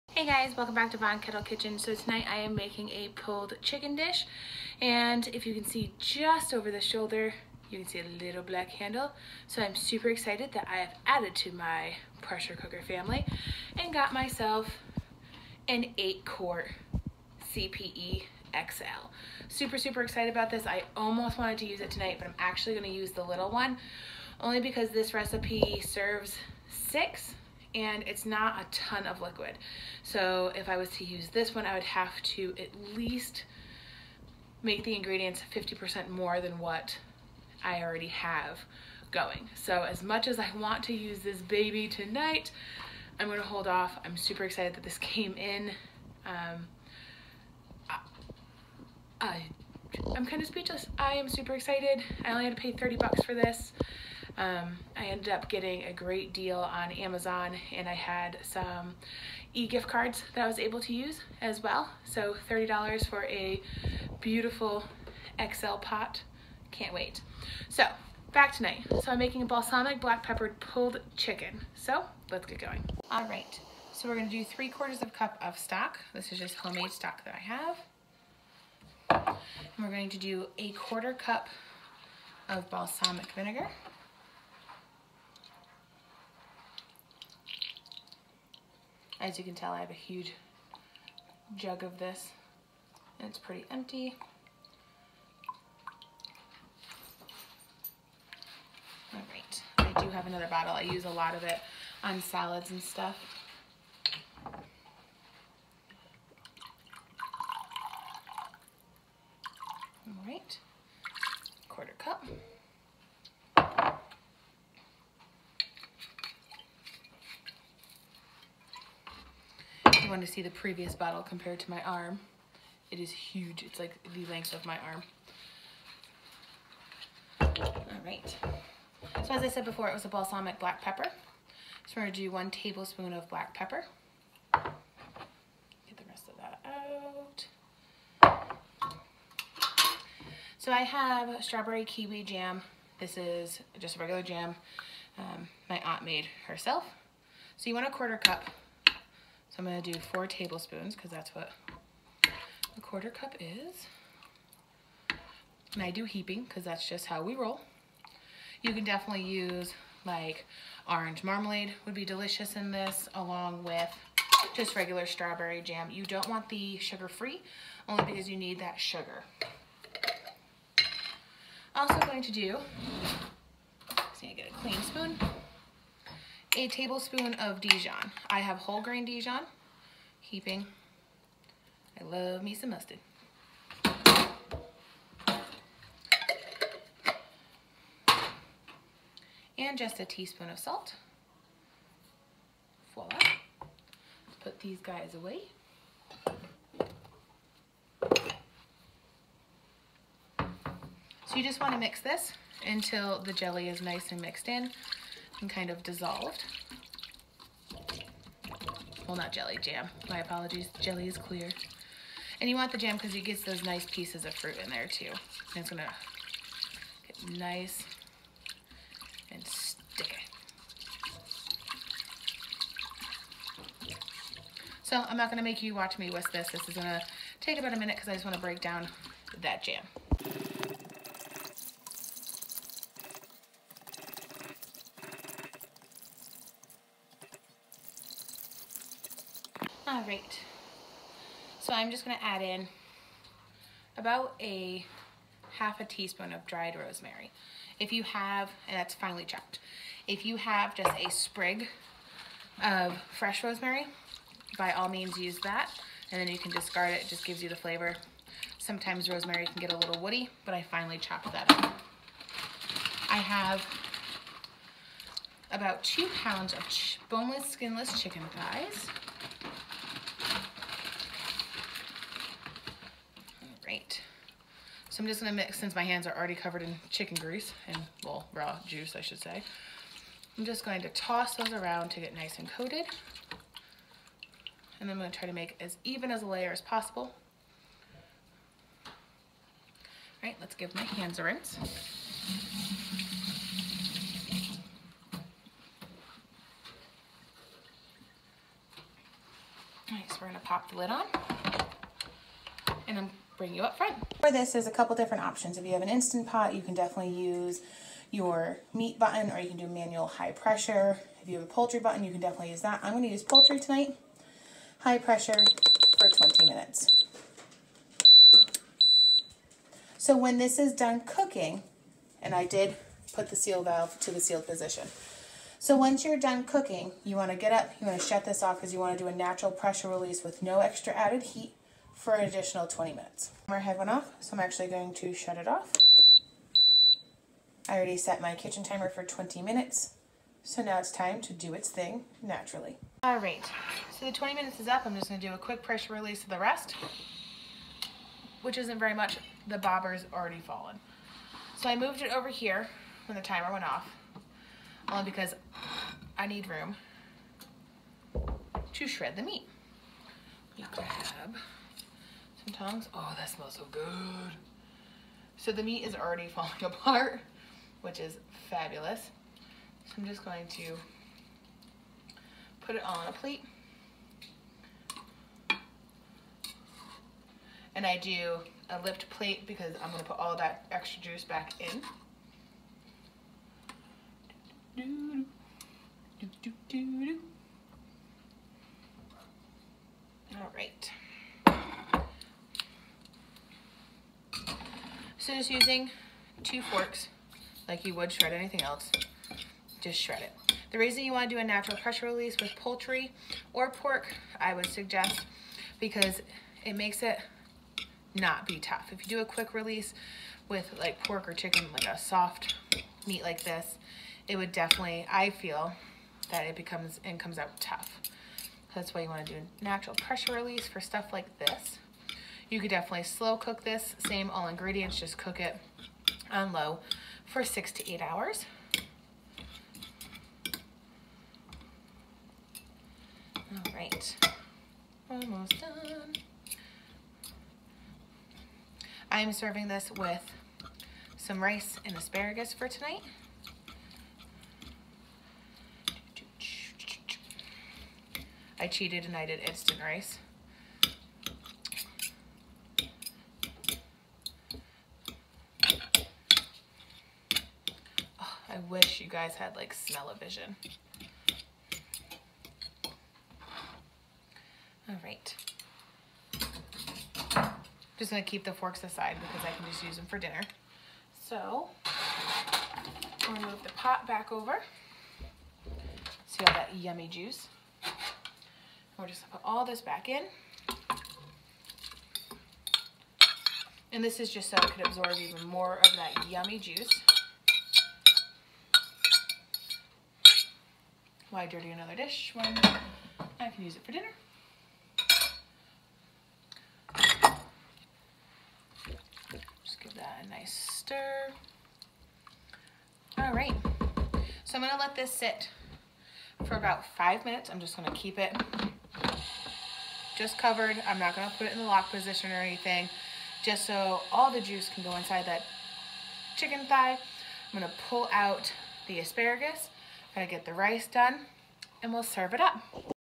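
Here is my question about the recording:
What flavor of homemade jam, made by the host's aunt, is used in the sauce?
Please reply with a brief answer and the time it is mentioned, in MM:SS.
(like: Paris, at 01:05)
strawberry kiwi, at 02:21.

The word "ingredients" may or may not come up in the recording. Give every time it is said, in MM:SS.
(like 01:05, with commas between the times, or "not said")
00:34, 07:04.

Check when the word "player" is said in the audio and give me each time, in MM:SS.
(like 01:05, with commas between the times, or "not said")
not said.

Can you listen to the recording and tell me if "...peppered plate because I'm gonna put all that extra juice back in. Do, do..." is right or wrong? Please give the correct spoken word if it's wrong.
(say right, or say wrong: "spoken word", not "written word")
wrong: "lipped", not "peppered".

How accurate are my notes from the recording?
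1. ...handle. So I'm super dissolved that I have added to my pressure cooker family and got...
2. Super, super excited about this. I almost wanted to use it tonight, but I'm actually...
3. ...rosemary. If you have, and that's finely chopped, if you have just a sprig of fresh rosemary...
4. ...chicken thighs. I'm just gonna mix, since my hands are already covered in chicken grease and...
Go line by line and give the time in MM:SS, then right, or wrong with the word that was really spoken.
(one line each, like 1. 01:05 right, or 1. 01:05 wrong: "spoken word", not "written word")
1. 00:08 wrong: "excited", not "dissolved"
2. 00:19 right
3. 04:06 right
4. 04:27 right.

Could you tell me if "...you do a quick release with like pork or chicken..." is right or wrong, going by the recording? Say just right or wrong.
right.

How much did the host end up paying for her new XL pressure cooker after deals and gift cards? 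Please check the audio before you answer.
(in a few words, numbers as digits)
$30.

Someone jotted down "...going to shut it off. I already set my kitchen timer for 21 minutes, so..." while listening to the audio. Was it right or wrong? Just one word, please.
wrong.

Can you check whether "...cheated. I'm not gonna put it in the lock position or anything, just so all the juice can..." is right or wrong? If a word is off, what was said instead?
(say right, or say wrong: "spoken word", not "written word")
wrong: "covered", not "cheated".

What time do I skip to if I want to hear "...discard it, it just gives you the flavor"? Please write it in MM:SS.
04:16.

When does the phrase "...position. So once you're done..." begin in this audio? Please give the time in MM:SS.
05:24.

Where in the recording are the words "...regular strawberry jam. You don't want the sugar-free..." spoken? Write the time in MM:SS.
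02:44.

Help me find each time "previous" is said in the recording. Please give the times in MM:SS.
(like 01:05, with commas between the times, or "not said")
02:00.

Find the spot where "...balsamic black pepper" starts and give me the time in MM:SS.
02:10.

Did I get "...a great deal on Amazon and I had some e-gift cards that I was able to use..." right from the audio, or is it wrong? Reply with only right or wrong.
right.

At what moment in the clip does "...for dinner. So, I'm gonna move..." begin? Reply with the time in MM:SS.
07:50.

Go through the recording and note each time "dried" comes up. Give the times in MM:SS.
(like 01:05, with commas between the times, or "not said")
04:06.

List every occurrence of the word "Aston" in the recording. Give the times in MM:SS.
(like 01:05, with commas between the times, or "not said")
not said.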